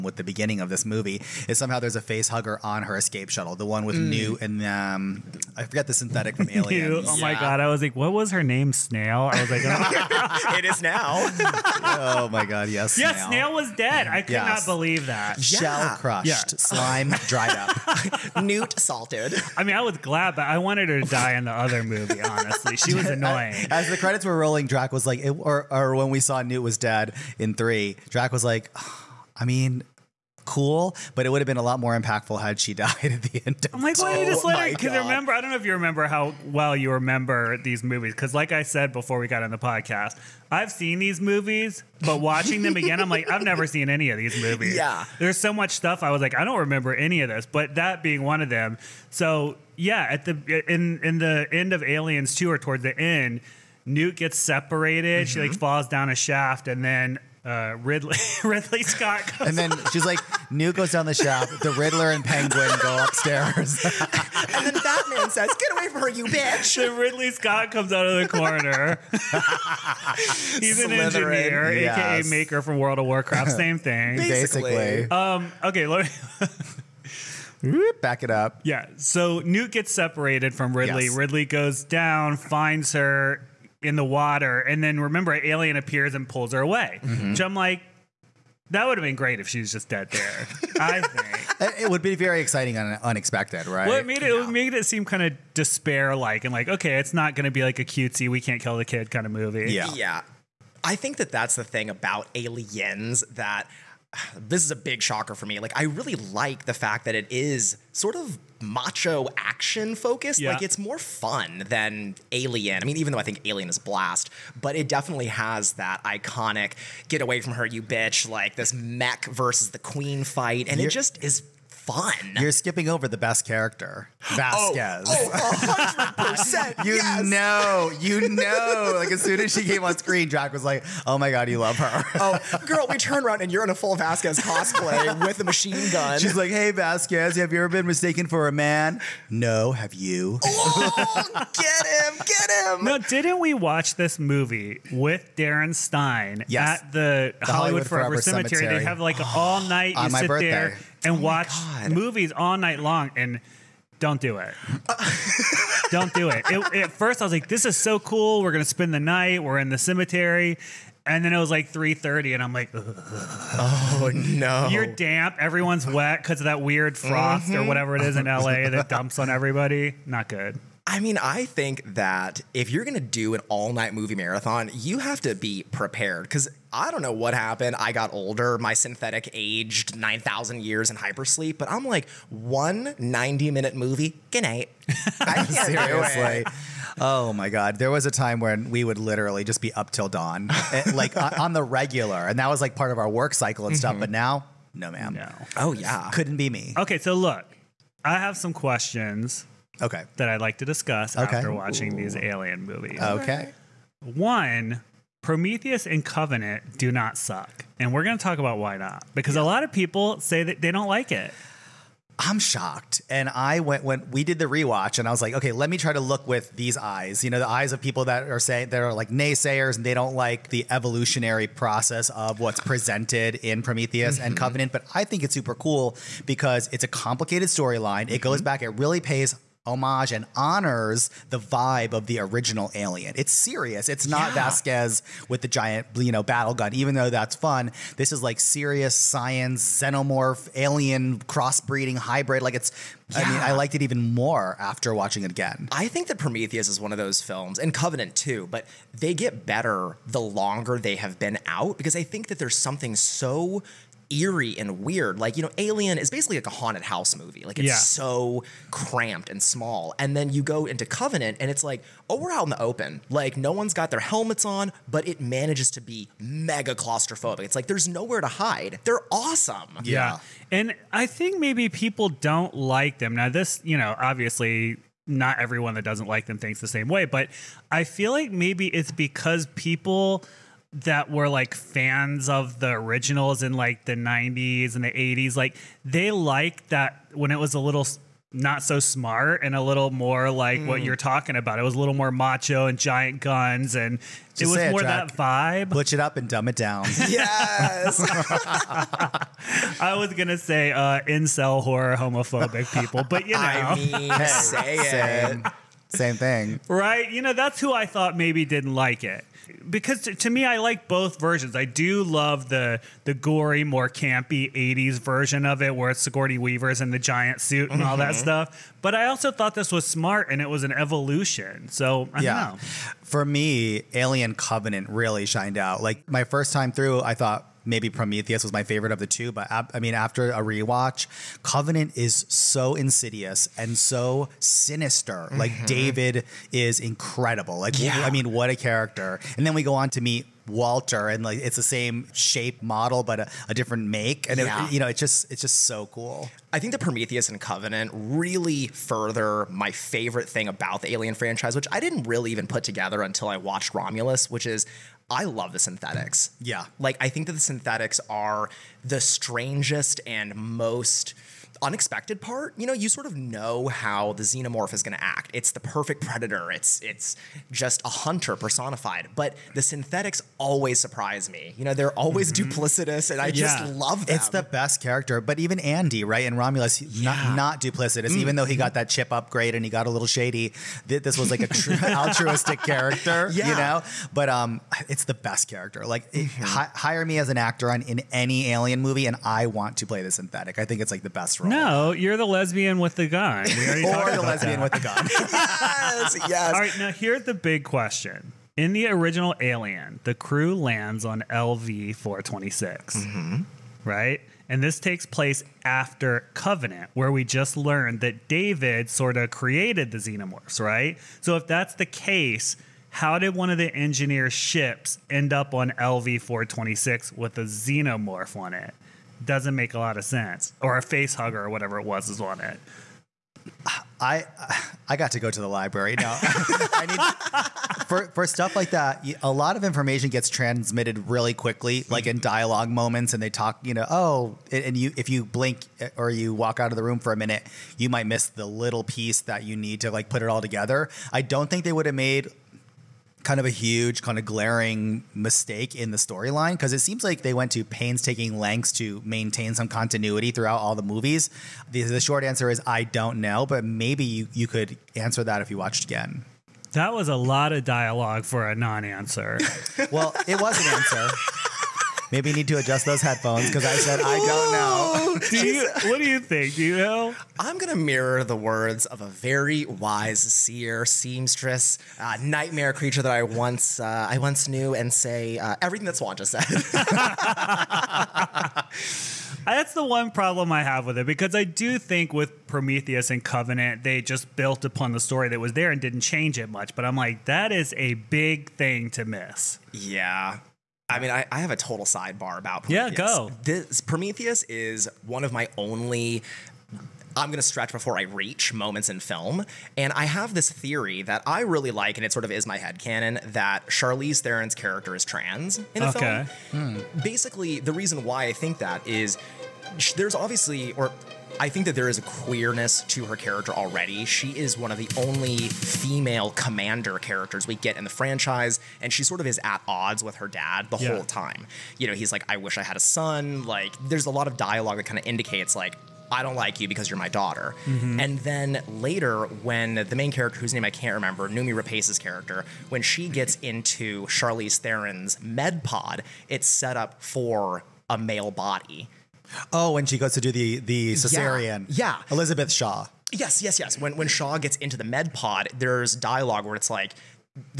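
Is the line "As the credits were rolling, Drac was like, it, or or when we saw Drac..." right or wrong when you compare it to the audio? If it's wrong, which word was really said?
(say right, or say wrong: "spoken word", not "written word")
wrong: "Newt", not "Drac".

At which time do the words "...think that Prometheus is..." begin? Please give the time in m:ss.
4:05.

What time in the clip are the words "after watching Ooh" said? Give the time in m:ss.
3:21.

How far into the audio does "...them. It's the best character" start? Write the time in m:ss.
6:14.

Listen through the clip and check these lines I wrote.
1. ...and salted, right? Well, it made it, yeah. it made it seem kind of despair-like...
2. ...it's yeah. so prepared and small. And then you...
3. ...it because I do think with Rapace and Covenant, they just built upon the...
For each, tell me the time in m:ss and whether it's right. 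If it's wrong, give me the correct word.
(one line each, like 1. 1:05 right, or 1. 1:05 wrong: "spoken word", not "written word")
1. 1:32 wrong: "unexpected", not "salted"
2. 4:17 wrong: "cramped", not "prepared"
3. 8:00 wrong: "Prometheus", not "Rapace".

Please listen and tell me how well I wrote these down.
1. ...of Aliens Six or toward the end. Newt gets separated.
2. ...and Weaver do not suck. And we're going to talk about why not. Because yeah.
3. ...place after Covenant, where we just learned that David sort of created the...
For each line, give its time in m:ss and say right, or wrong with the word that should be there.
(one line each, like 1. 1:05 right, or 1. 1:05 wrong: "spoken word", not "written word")
1. 0:51 wrong: "Two", not "Six"
2. 3:25 wrong: "Covenant", not "Weaver"
3. 6:45 right.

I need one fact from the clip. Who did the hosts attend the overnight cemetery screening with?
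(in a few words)
Darren Stein.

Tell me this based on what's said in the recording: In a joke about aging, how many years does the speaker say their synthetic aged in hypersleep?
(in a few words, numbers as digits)
9,000.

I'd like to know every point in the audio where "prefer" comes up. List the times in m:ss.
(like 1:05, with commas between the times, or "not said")
not said.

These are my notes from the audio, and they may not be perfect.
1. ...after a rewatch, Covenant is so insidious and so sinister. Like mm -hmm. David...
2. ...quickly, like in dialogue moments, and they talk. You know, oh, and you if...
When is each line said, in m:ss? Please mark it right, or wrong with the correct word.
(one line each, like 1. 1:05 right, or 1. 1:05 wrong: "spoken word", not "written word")
1. 5:29 right
2. 7:11 right.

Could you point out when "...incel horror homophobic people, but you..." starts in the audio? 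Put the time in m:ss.
5:01.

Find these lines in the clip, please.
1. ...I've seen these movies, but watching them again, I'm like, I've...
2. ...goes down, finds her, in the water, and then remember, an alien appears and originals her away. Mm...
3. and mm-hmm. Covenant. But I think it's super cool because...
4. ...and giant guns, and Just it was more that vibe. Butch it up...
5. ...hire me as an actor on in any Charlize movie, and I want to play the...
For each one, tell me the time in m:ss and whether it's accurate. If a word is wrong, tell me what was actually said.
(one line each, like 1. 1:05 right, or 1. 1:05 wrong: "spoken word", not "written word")
1. 0:40 right
2. 1:21 wrong: "pulls", not "originals"
3. 3:44 right
4. 4:52 right
5. 6:26 wrong: "Alien", not "Charlize".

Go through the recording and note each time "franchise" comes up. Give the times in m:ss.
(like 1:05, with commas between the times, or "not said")
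5:51, 8:37.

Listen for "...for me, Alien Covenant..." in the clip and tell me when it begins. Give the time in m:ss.
5:23.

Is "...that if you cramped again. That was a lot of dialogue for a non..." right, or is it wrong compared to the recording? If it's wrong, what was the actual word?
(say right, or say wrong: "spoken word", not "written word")
wrong: "watched", not "cramped".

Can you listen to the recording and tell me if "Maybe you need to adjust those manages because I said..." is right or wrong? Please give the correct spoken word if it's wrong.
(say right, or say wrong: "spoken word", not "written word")
wrong: "headphones", not "manages".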